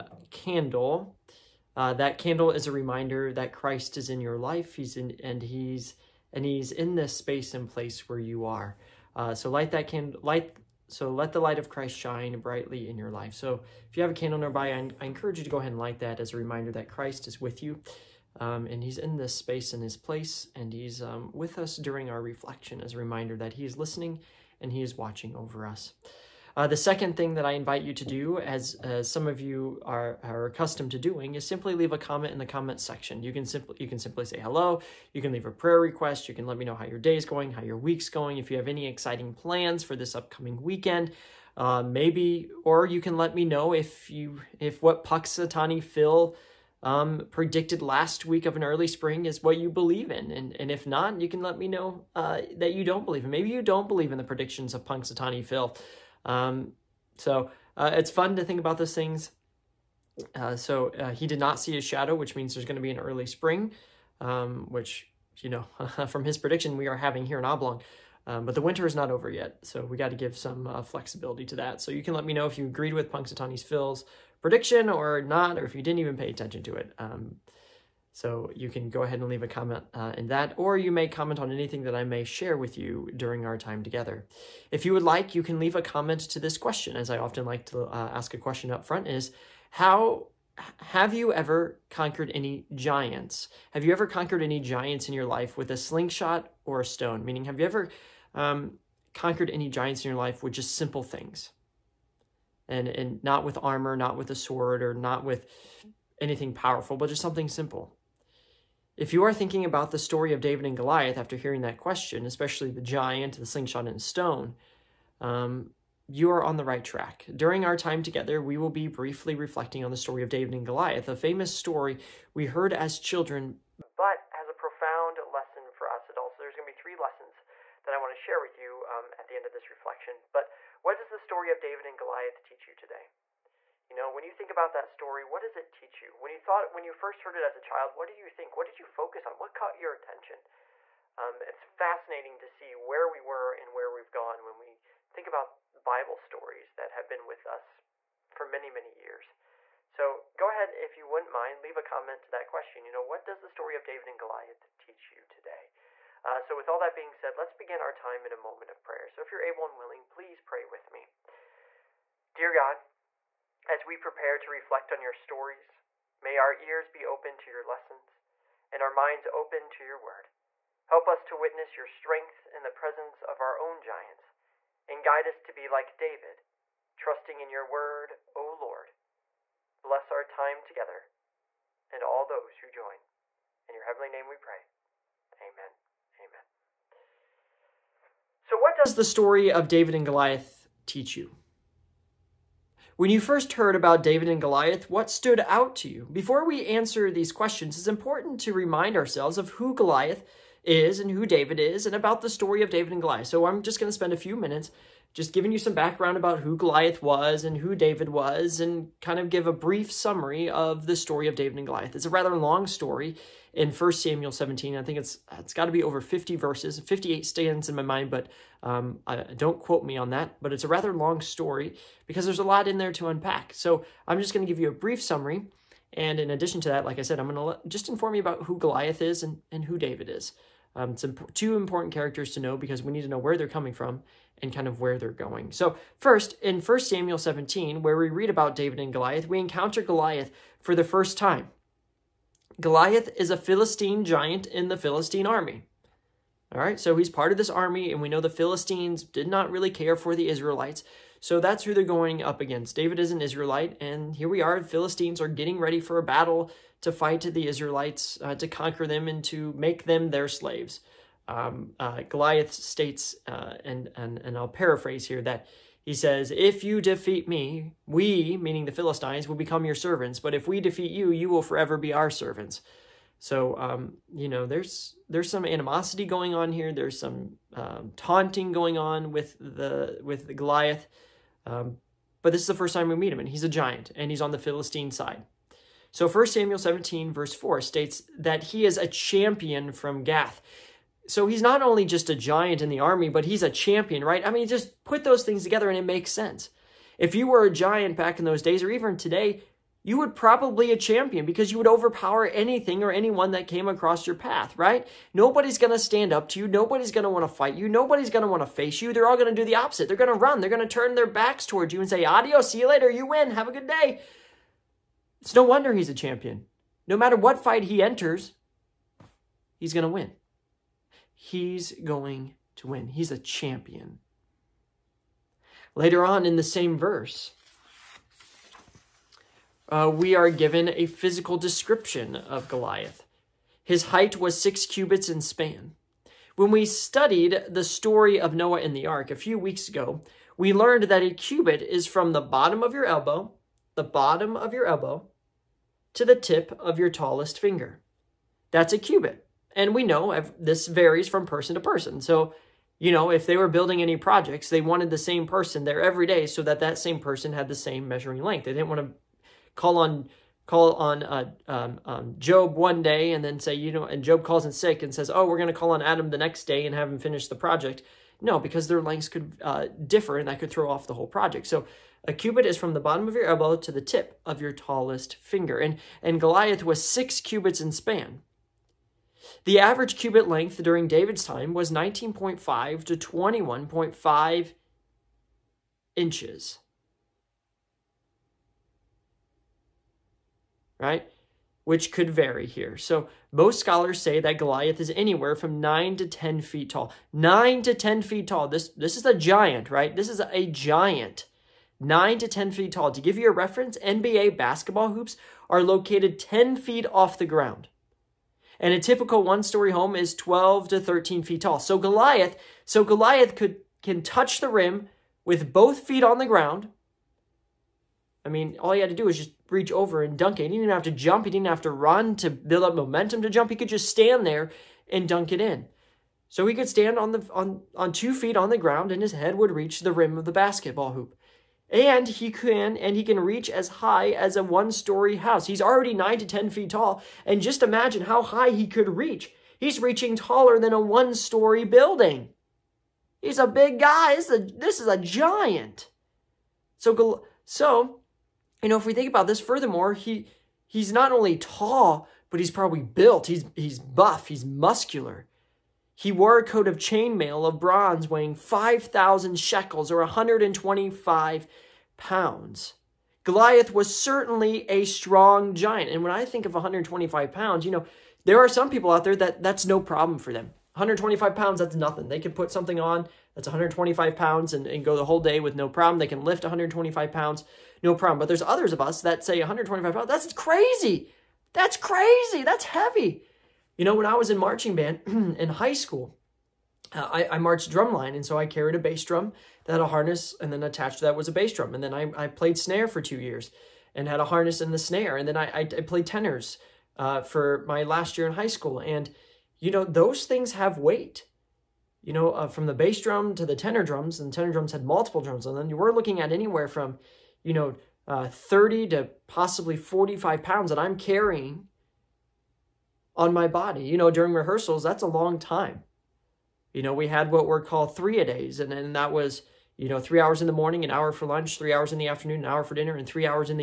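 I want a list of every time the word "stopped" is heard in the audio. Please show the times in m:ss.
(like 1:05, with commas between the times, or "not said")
not said.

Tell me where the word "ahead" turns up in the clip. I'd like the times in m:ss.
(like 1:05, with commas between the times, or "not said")
0:15, 1:19, 2:30.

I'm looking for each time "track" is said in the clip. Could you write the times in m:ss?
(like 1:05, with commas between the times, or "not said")
1:56.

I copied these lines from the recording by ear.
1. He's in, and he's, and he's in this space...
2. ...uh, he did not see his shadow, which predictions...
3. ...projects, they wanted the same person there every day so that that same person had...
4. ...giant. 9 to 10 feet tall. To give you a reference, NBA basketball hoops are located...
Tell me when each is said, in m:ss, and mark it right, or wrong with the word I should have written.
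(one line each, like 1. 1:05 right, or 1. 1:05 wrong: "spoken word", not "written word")
1. 0:04 right
2. 1:00 wrong: "means", not "predictions"
3. 5:53 right
4. 6:40 right.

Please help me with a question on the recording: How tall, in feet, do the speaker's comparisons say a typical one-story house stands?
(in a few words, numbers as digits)
12 to 13 feet.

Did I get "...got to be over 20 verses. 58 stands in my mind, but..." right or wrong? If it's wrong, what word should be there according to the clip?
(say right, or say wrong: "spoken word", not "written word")
wrong: "50", not "20".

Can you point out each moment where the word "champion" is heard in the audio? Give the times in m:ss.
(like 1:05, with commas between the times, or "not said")
4:48, 4:53, 5:00, 5:15, 5:23.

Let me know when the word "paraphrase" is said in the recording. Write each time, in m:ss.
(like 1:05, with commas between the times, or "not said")
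4:24.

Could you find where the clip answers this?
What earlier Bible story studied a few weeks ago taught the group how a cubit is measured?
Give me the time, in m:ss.
5:38.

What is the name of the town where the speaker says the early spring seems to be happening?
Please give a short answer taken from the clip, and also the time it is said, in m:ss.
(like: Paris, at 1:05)
Oblong, at 1:07.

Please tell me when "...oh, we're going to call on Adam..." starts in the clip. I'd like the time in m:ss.
6:05.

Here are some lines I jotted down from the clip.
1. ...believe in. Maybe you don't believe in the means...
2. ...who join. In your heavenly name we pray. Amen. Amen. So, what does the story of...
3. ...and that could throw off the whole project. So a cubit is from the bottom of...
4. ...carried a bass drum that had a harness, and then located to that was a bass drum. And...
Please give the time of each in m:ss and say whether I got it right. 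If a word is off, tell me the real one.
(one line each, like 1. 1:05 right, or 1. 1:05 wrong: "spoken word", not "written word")
1. 0:53 wrong: "predictions", not "means"
2. 3:02 right
3. 6:10 right
4. 8:08 wrong: "attached", not "located".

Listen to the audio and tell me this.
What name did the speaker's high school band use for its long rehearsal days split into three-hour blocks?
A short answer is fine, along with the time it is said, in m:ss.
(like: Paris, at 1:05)
three a days, at 8:37.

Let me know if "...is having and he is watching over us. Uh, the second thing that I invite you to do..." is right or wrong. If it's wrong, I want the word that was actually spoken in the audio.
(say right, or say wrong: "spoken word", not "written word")
wrong: "listening", not "having".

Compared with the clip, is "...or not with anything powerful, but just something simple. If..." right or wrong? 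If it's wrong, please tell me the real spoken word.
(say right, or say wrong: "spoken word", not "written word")
right.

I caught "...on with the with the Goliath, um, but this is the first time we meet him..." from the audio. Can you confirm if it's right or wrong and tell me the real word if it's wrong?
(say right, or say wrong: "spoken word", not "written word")
right.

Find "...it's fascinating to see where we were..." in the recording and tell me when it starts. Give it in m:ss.
2:21.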